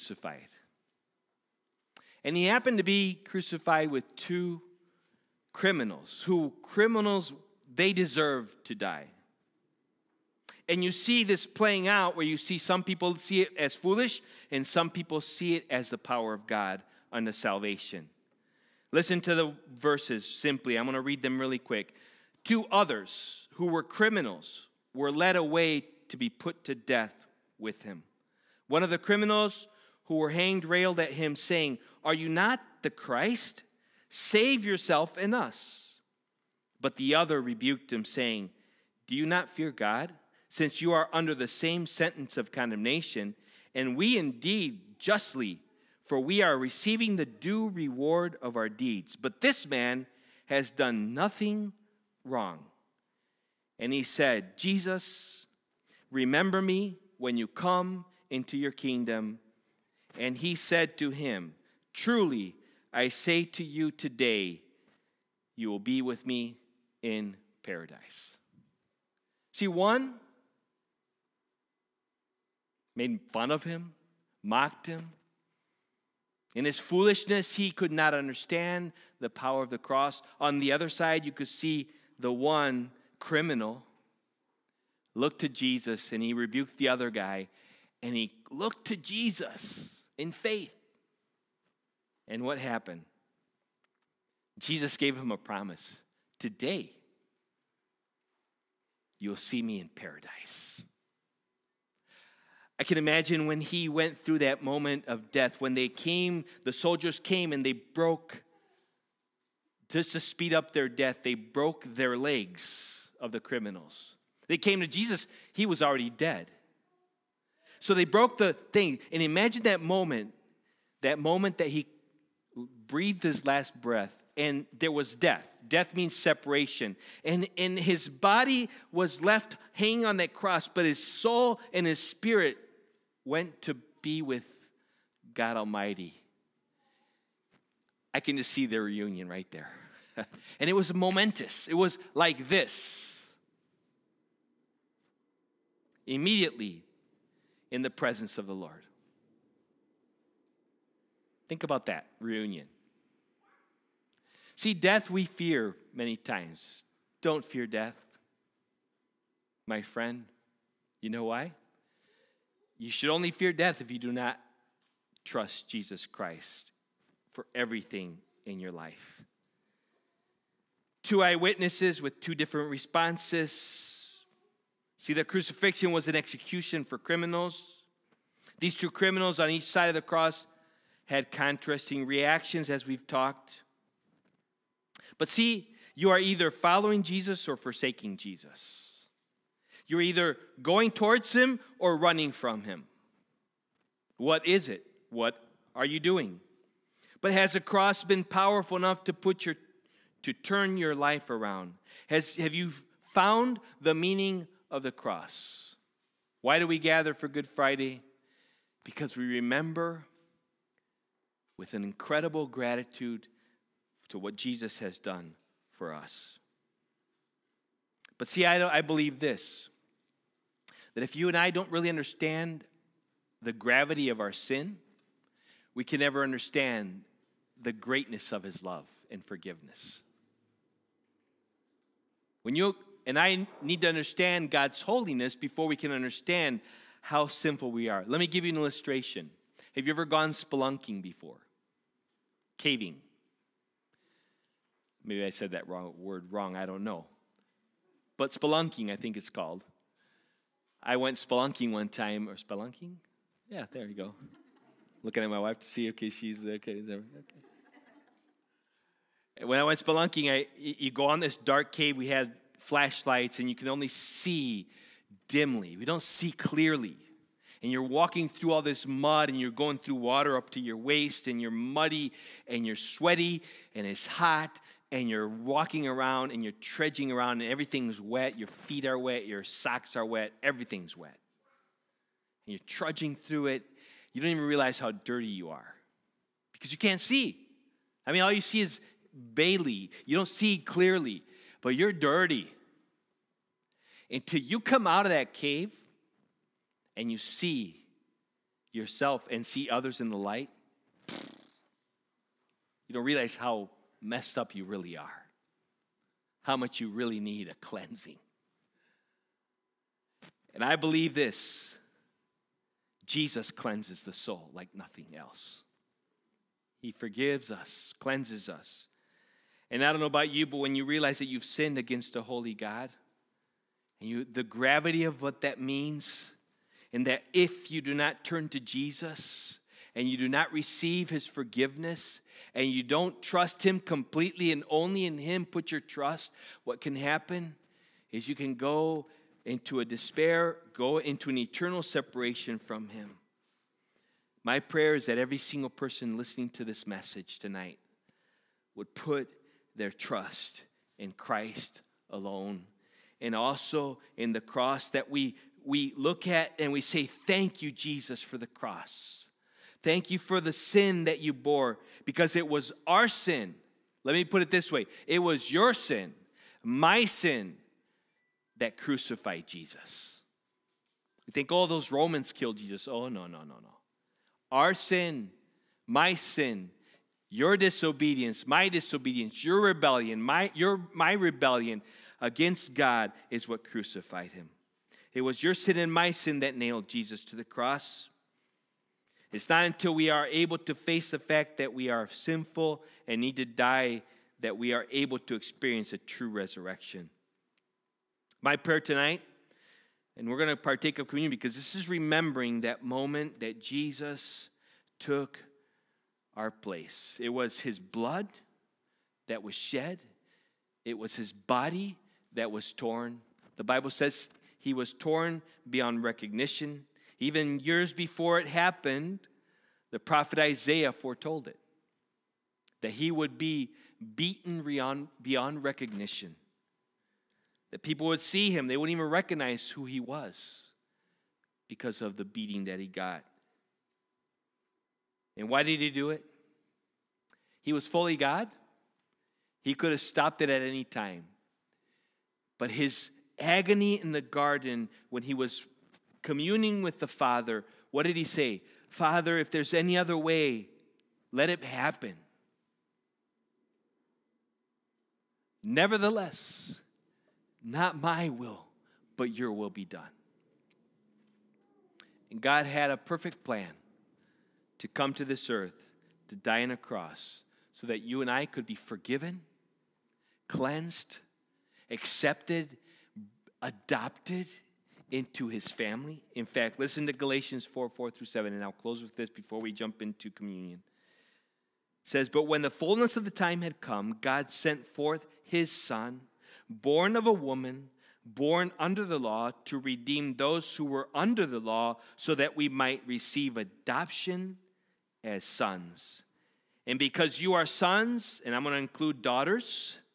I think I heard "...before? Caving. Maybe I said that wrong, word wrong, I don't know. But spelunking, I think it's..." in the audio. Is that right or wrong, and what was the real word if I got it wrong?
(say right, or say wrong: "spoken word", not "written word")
right.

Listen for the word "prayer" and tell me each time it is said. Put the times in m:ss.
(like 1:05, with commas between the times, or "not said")
5:44, 6:38.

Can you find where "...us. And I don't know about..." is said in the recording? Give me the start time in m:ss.
5:18.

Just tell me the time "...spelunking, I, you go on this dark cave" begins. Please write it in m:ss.
4:19.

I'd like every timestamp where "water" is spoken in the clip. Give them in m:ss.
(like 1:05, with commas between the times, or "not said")
4:29.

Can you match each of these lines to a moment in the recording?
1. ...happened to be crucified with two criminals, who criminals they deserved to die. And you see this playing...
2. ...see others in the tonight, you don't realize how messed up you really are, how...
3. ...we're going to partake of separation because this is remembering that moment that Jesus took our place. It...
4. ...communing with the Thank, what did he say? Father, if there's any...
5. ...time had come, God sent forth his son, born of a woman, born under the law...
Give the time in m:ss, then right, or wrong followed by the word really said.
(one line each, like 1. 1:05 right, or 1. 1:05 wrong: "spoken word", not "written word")
1. 0:02 right
2. 4:59 wrong: "light", not "tonight"
3. 6:40 wrong: "communion", not "separation"
4. 7:26 wrong: "Father", not "Thank"
5. 8:03 right.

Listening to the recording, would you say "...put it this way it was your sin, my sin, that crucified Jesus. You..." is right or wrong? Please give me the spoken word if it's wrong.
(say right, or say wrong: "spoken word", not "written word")
right.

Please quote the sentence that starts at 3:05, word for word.
But see, you are either following Jesus or forsaking Jesus.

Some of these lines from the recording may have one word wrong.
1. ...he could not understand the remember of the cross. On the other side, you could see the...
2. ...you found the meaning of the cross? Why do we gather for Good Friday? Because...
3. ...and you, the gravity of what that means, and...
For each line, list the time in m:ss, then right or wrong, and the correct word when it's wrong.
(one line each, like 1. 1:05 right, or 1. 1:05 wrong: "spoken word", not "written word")
1. 1:17 wrong: "power", not "remember"
2. 3:22 right
3. 5:24 right.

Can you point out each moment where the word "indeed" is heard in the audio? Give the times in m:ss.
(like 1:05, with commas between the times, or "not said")
0:44.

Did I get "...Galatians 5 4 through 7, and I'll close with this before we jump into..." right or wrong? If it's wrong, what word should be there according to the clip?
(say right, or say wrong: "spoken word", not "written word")
wrong: "4", not "5".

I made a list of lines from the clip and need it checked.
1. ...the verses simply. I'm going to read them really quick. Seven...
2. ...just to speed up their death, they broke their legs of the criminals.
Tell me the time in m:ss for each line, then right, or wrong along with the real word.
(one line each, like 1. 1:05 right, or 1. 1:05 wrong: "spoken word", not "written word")
1. 0:19 wrong: "Two", not "Seven"
2. 1:49 right.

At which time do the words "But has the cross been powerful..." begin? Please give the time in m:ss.
3:17.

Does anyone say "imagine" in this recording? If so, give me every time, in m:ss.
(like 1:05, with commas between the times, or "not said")
1:42, 1:59.